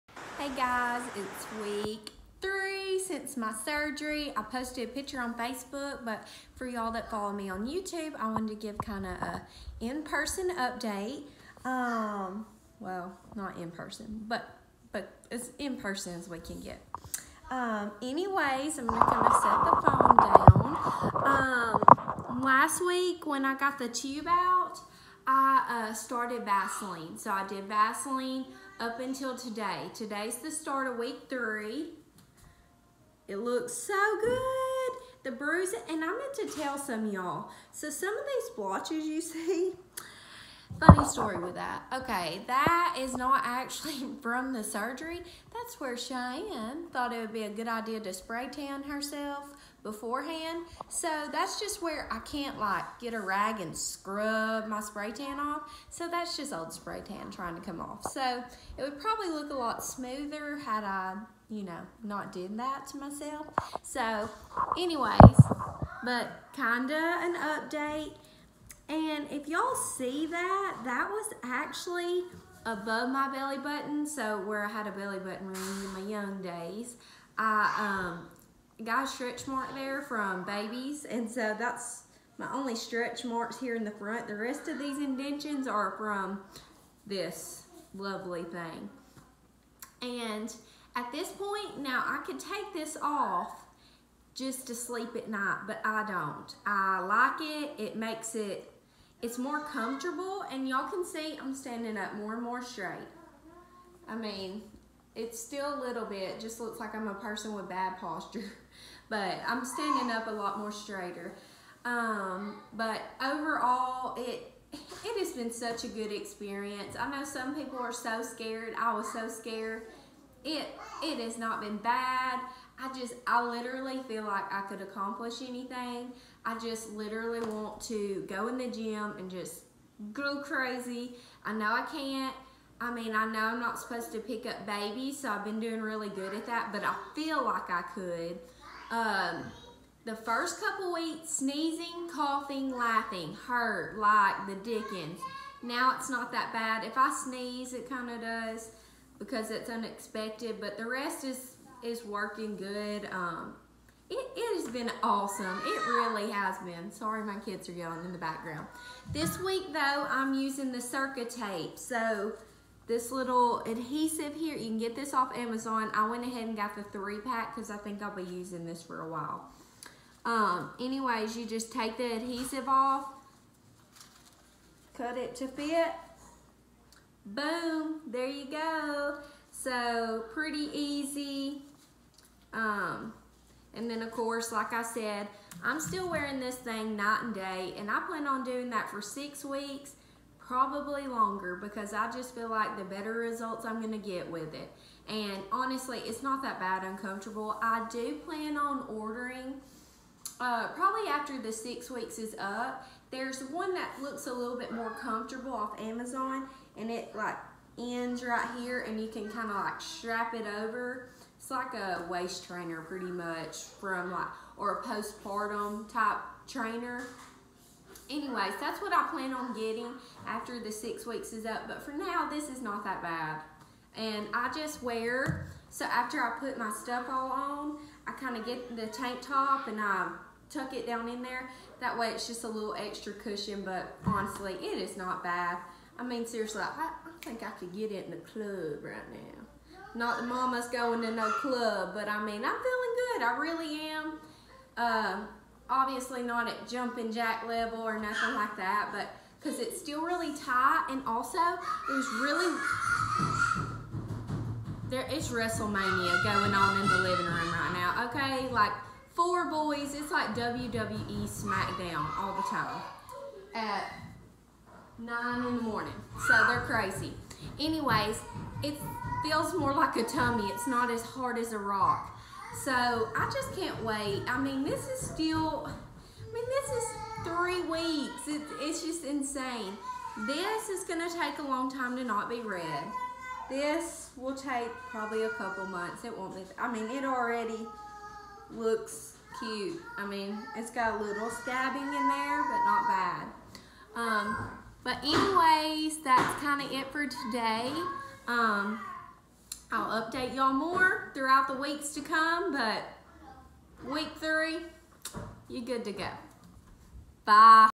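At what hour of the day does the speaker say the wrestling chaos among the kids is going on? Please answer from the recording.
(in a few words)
9 in the morning.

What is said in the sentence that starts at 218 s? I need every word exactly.
Anyways, that's what I plan on getting after the six weeks is up.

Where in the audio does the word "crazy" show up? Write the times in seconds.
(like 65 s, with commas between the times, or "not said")
130 s, 266 s.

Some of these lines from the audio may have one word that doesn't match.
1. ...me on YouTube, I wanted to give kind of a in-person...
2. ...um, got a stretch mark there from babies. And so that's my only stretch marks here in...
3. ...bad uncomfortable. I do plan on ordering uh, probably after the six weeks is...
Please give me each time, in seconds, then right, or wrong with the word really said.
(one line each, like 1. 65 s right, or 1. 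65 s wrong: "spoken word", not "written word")
1. 7 s right
2. 77 s right
3. 196 s right.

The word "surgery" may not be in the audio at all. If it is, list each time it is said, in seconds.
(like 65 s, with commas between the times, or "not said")
3 s, 44 s.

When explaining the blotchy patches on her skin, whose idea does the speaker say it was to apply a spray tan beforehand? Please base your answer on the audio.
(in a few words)
Cheyenne.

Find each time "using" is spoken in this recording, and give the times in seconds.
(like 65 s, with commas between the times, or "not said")
160 s, 168 s.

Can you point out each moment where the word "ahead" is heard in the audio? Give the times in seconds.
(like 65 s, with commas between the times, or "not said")
166 s.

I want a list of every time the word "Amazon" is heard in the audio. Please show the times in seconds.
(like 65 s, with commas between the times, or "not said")
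165 s, 205 s.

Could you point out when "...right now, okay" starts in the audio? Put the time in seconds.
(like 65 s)
257 s.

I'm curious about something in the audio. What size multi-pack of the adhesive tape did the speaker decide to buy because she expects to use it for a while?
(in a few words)
3 pack.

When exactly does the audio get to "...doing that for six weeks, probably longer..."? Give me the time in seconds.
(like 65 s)
188 s.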